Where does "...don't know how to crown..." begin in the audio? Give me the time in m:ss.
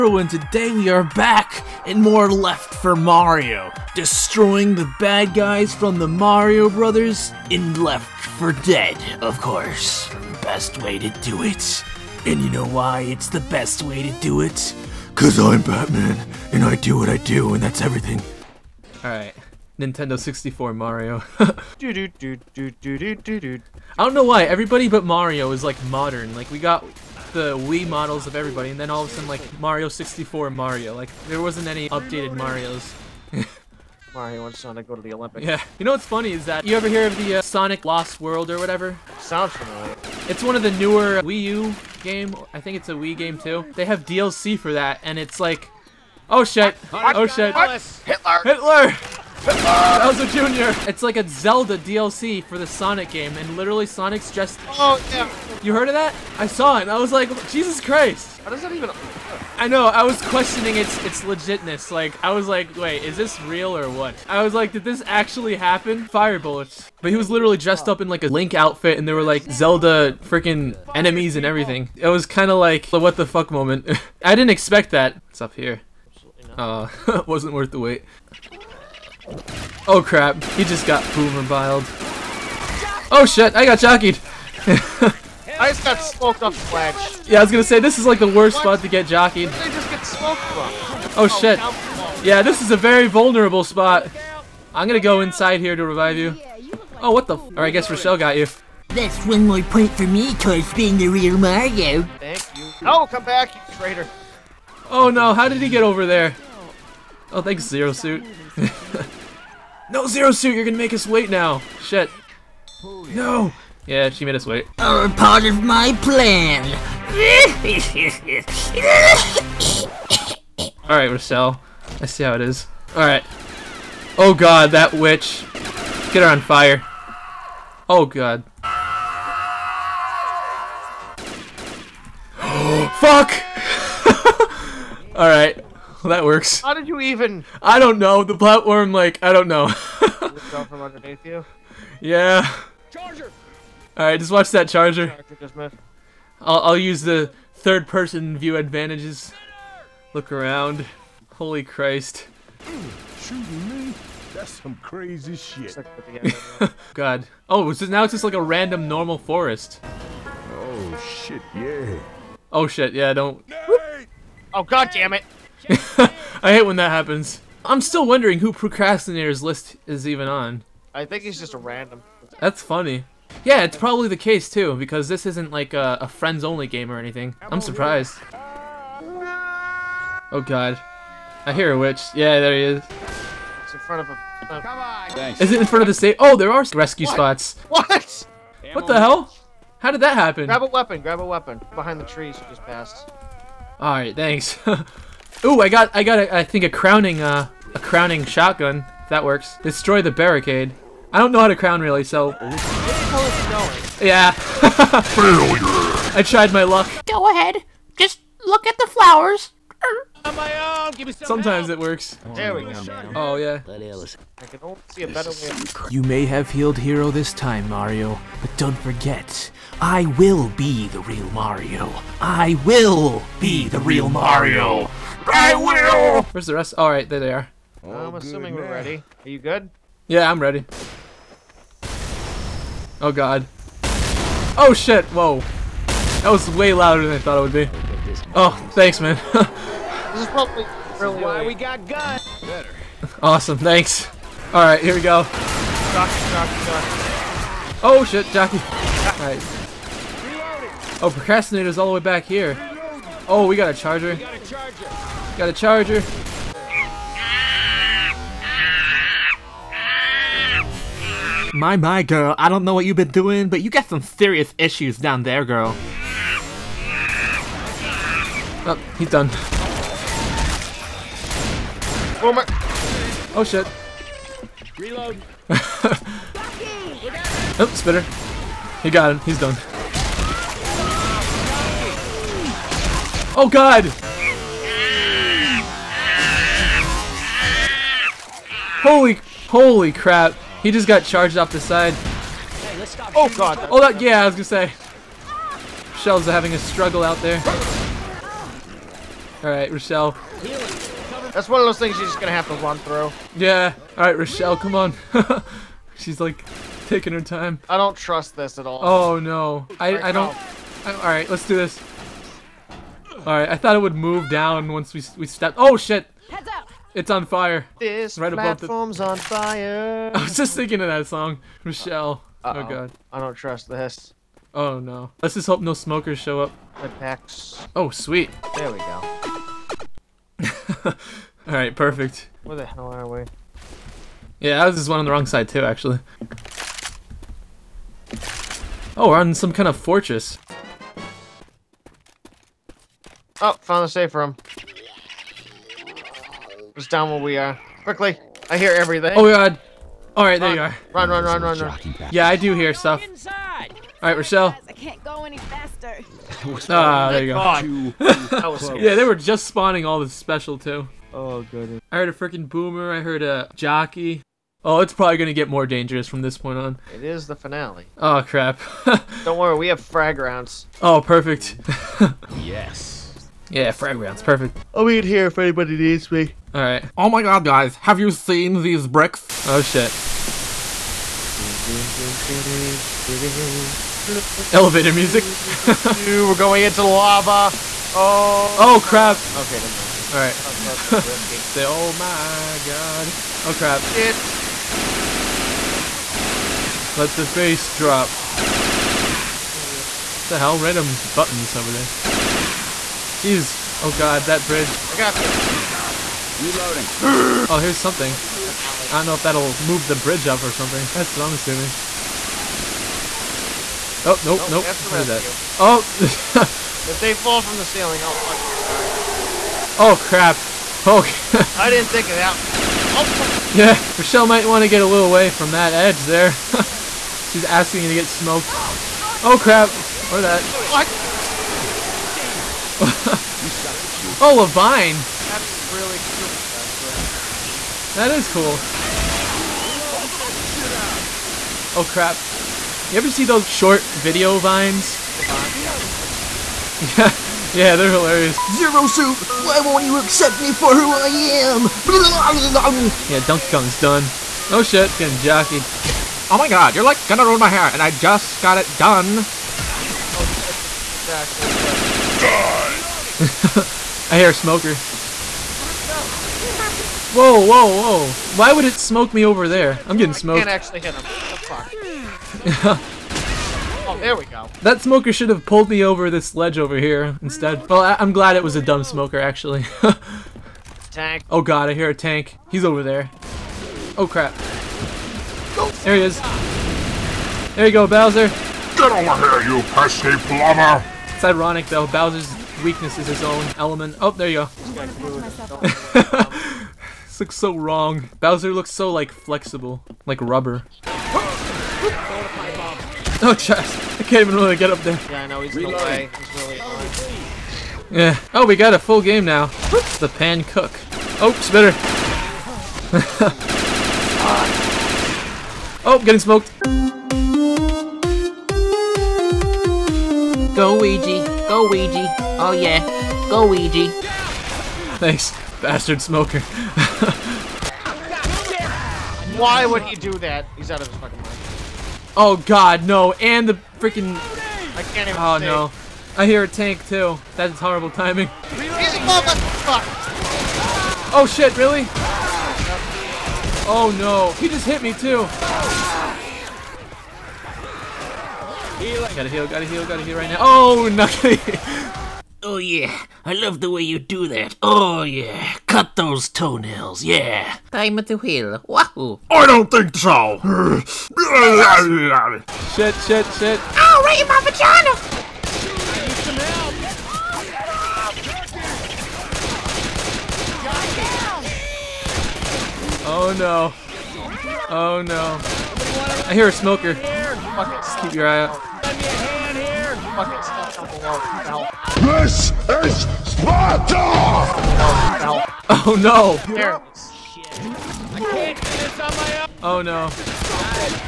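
3:21.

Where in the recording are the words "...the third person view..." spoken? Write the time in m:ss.
2:27.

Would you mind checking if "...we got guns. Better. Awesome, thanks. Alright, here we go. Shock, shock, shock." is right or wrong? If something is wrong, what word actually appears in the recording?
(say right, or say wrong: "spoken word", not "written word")
right.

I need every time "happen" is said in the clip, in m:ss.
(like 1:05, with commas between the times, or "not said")
1:05, 2:46, 3:10.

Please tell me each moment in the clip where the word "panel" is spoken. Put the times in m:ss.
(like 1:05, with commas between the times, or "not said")
not said.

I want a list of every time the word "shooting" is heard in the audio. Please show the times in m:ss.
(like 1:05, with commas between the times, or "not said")
2:33, 7:13.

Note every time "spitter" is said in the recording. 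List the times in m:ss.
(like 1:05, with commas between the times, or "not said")
4:37, 8:31.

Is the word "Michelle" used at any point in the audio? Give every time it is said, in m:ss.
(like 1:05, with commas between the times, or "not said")
5:21, 7:03.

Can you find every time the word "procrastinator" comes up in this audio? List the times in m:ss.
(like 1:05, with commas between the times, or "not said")
2:48, 4:11.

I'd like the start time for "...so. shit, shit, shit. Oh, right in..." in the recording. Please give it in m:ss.
9:19.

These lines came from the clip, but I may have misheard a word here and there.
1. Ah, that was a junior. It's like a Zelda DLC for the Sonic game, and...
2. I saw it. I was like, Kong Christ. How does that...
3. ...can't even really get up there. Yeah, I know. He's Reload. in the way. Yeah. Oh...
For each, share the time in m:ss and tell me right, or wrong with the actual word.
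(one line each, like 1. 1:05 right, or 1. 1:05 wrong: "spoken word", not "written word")
1. 0:49 right
2. 0:56 wrong: "Jesus", not "Kong"
3. 8:24 right.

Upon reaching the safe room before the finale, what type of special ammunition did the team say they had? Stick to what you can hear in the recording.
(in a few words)
frag rounds.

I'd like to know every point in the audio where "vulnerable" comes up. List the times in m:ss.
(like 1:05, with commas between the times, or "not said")
1:33.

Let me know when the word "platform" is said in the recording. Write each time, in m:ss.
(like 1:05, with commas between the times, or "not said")
2:18, 5:18.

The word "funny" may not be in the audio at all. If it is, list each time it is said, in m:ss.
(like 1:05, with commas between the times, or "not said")
0:36, 2:52.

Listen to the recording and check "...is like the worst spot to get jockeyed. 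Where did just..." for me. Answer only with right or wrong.
right.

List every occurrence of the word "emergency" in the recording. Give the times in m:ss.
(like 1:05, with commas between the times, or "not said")
not said.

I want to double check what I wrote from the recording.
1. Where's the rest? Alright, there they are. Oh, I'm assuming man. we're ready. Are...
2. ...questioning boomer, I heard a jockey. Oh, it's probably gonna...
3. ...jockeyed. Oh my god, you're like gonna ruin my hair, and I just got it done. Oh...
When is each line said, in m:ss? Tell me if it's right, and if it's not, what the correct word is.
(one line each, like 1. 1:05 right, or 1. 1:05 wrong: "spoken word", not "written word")
1. 3:46 right
2. 6:02 wrong: "freaking", not "questioning"
3. 7:35 right.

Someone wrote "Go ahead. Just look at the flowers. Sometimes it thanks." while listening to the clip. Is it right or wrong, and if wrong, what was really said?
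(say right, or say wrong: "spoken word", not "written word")
wrong: "works", not "thanks".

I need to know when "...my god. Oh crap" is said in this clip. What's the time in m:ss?
6:31.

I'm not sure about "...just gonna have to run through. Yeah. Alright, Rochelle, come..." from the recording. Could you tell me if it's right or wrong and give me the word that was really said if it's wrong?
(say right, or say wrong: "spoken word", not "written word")
right.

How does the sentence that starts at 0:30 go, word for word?
Like, there wasn't any updated Marios.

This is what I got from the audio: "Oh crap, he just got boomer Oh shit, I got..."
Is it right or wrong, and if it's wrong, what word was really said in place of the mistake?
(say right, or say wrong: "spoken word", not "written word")
right.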